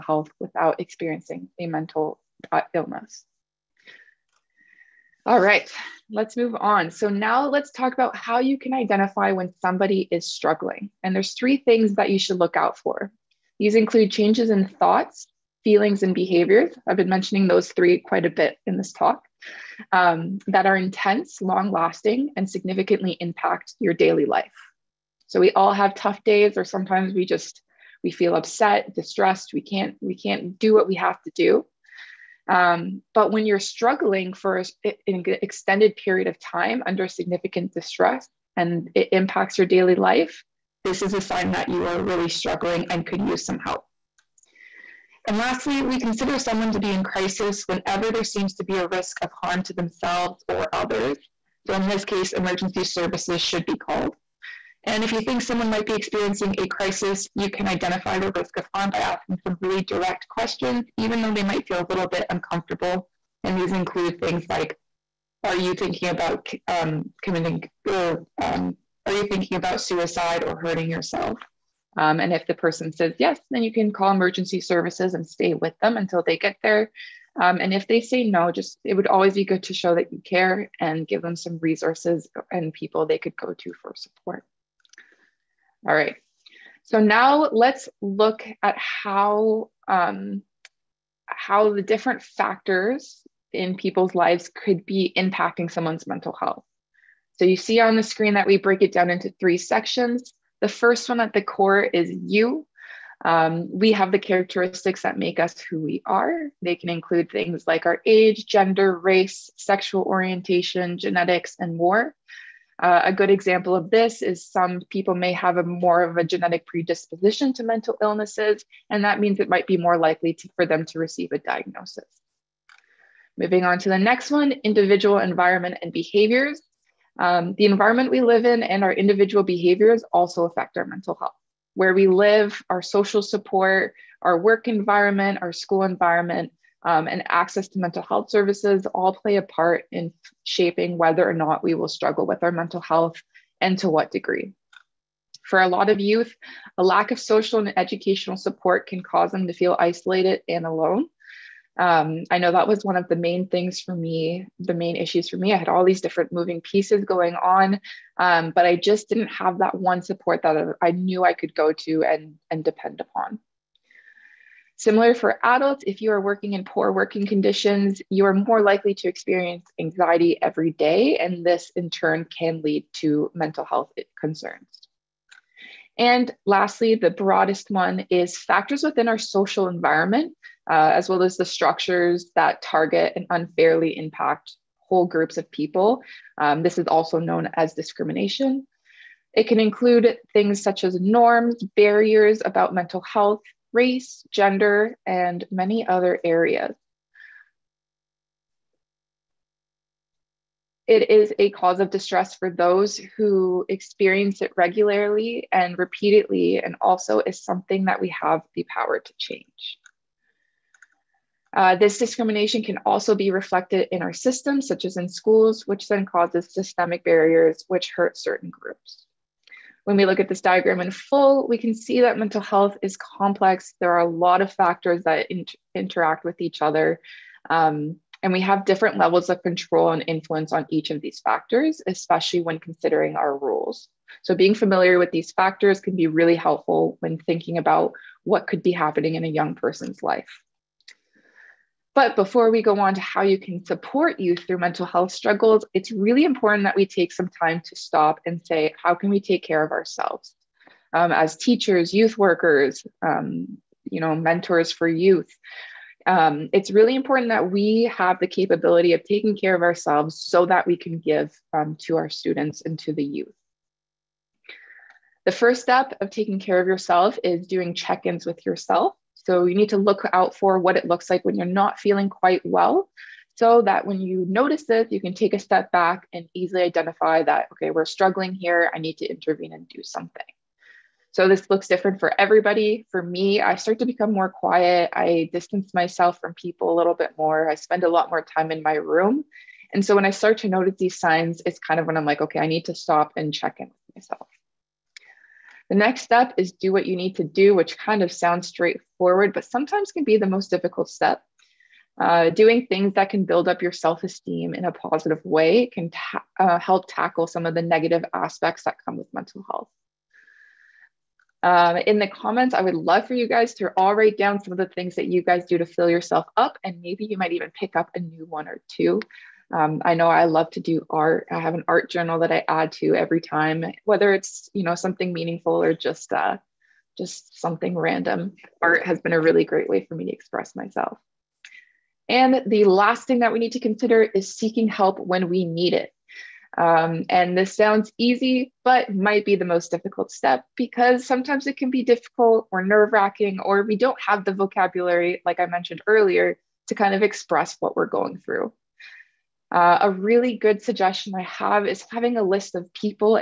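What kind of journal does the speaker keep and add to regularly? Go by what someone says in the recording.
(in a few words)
art journal.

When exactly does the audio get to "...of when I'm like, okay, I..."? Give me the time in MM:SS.
04:51.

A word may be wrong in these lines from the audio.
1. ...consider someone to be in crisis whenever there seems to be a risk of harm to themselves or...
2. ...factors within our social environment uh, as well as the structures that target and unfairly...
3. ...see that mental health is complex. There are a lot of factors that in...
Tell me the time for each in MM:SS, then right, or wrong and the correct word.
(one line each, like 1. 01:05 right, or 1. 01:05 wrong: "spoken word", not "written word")
1. 00:45 right
2. 02:58 right
3. 03:41 right.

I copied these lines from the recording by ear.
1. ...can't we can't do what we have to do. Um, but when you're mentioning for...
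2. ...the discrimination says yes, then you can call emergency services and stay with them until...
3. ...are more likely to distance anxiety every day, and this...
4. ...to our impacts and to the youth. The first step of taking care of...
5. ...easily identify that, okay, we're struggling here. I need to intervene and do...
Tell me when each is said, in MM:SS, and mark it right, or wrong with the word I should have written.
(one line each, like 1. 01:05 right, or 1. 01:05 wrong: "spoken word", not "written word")
1. 00:29 wrong: "struggling", not "mentioning"
2. 01:12 wrong: "person", not "discrimination"
3. 02:48 wrong: "experience", not "distance"
4. 04:21 wrong: "students", not "impacts"
5. 04:36 right.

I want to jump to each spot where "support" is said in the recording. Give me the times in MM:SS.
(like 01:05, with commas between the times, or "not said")
01:23, 02:13, 02:28, 02:40, 04:03.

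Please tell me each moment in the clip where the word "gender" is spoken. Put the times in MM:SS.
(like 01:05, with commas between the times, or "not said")
01:48, 03:14.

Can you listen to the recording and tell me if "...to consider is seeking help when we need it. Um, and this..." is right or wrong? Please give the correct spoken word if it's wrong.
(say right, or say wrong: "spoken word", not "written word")
right.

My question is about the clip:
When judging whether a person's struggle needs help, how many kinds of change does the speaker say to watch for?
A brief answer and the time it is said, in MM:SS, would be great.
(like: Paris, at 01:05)
3, at 00:11.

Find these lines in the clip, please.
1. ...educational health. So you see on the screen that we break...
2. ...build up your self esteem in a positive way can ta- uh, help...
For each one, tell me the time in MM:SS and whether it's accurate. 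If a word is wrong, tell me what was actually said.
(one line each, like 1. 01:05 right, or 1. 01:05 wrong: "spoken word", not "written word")
1. 01:36 wrong: "mental", not "educational"
2. 05:03 right.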